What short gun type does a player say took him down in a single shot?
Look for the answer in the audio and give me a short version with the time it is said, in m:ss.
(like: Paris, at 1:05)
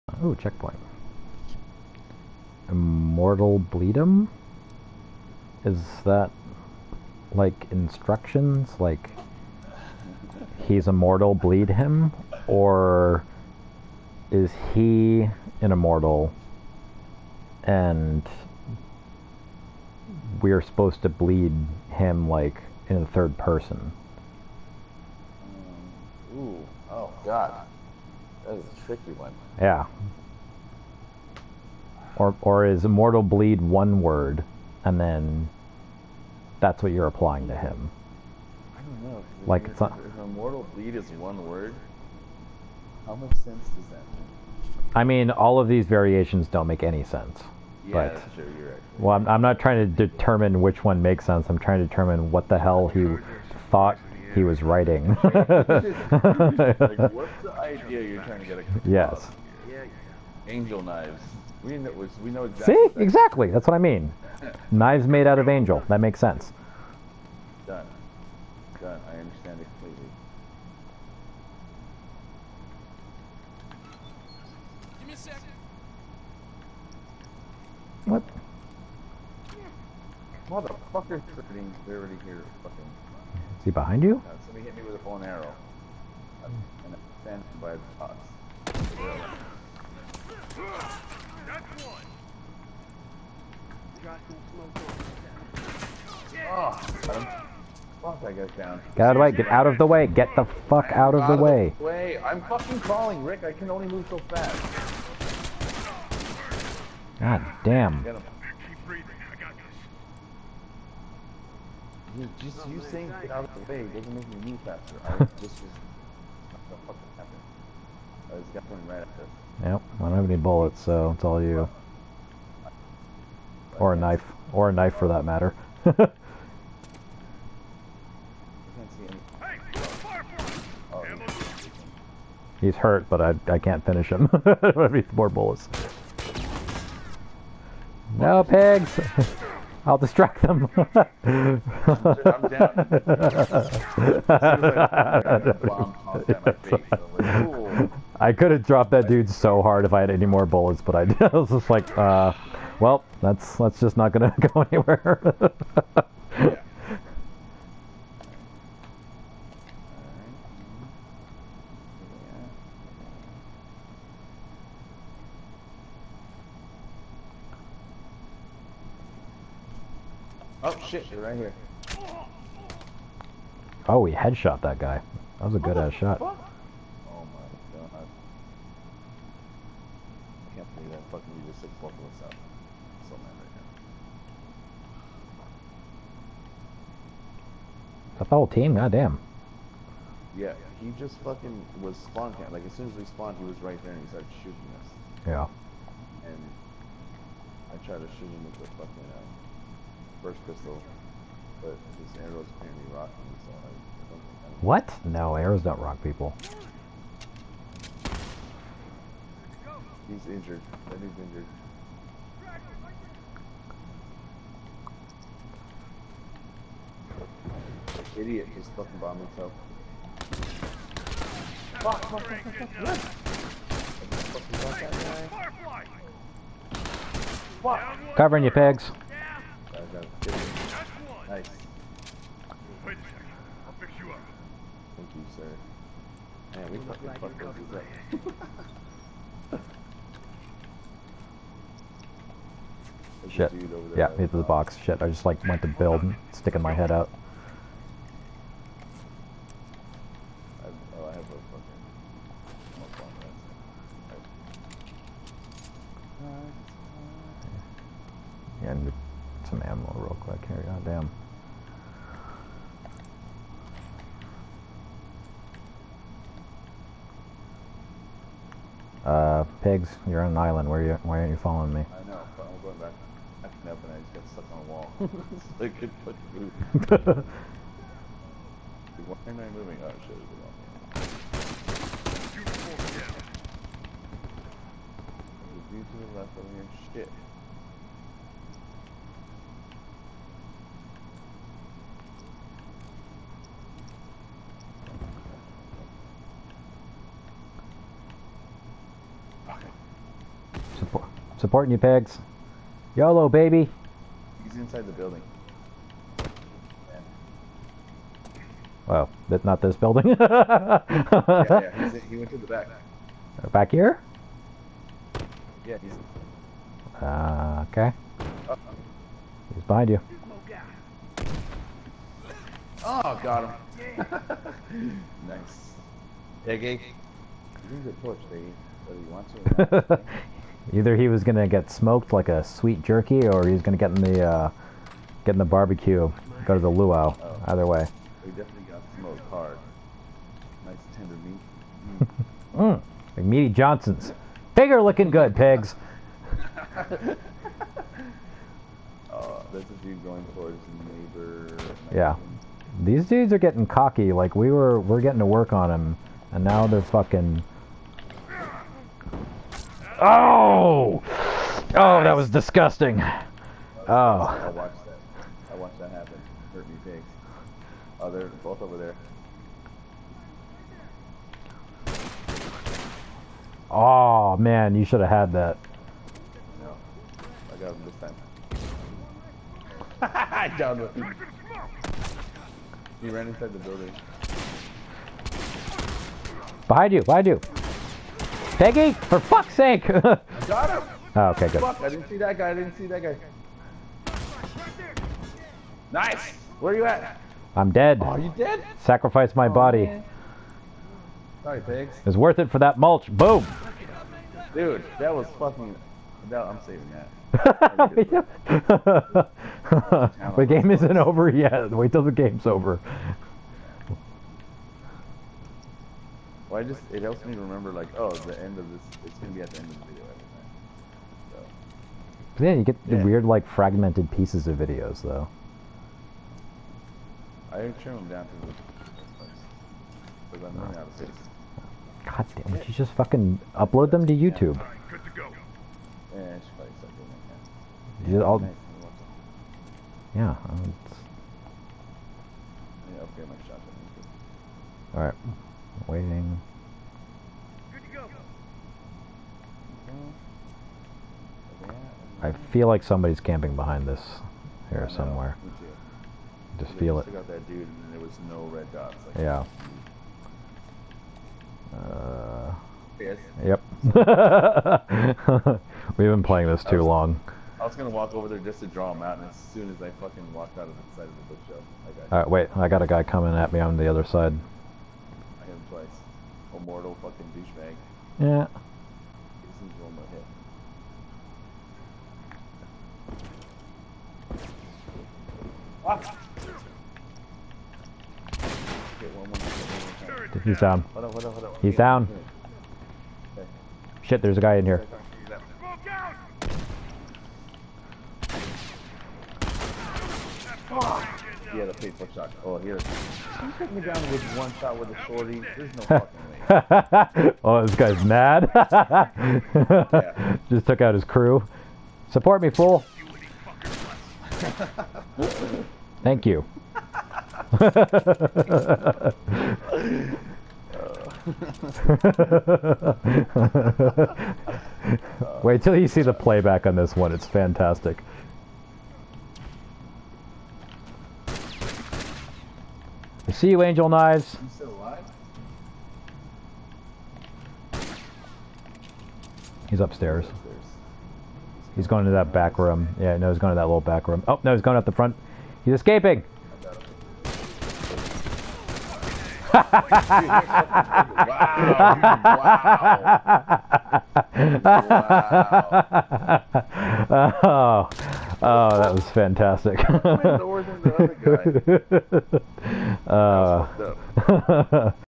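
shorty, at 8:25.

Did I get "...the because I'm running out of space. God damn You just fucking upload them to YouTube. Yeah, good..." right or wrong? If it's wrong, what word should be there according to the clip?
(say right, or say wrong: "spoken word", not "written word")
right.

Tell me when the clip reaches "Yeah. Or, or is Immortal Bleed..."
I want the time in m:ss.
0:29.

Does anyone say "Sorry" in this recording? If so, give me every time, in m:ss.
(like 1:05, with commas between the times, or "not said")
6:41.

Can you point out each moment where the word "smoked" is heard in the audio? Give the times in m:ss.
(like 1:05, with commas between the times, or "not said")
5:31, 5:38.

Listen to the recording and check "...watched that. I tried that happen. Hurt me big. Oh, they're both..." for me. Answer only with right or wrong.
wrong.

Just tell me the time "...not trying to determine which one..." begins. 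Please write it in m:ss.
0:49.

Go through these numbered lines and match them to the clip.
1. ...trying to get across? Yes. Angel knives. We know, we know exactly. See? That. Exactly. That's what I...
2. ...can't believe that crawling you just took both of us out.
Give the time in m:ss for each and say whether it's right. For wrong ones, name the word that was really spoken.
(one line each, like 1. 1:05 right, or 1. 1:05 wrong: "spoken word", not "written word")
1. 0:58 right
2. 3:00 wrong: "fucking", not "crawling".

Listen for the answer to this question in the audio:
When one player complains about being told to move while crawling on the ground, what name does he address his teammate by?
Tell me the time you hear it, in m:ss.
1:43.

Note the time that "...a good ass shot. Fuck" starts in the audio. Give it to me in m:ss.
2:55.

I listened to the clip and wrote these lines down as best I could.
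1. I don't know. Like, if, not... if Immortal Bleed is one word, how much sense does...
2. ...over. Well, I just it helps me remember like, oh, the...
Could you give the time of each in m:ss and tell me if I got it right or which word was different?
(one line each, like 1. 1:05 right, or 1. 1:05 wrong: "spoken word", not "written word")
1. 0:38 right
2. 6:52 right.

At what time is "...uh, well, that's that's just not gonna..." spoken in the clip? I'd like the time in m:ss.
2:31.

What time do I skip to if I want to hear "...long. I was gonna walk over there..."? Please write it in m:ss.
7:46.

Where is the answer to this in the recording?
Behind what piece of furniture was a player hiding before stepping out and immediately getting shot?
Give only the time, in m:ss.
7:51.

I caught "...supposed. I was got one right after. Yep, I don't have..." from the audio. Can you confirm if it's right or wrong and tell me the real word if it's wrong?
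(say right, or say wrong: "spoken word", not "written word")
wrong: "happened", not "supposed".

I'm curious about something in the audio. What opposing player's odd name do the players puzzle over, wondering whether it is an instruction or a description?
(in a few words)
Immortal Bleedum.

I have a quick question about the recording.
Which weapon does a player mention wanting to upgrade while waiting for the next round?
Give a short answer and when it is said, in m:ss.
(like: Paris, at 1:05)
shotgun, at 7:23.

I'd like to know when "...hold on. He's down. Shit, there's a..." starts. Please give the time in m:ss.
8:11.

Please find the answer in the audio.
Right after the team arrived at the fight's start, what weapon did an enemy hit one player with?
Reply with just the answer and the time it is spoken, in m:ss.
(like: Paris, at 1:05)
bow and arrow, at 1:25.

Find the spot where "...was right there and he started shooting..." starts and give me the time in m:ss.
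3:13.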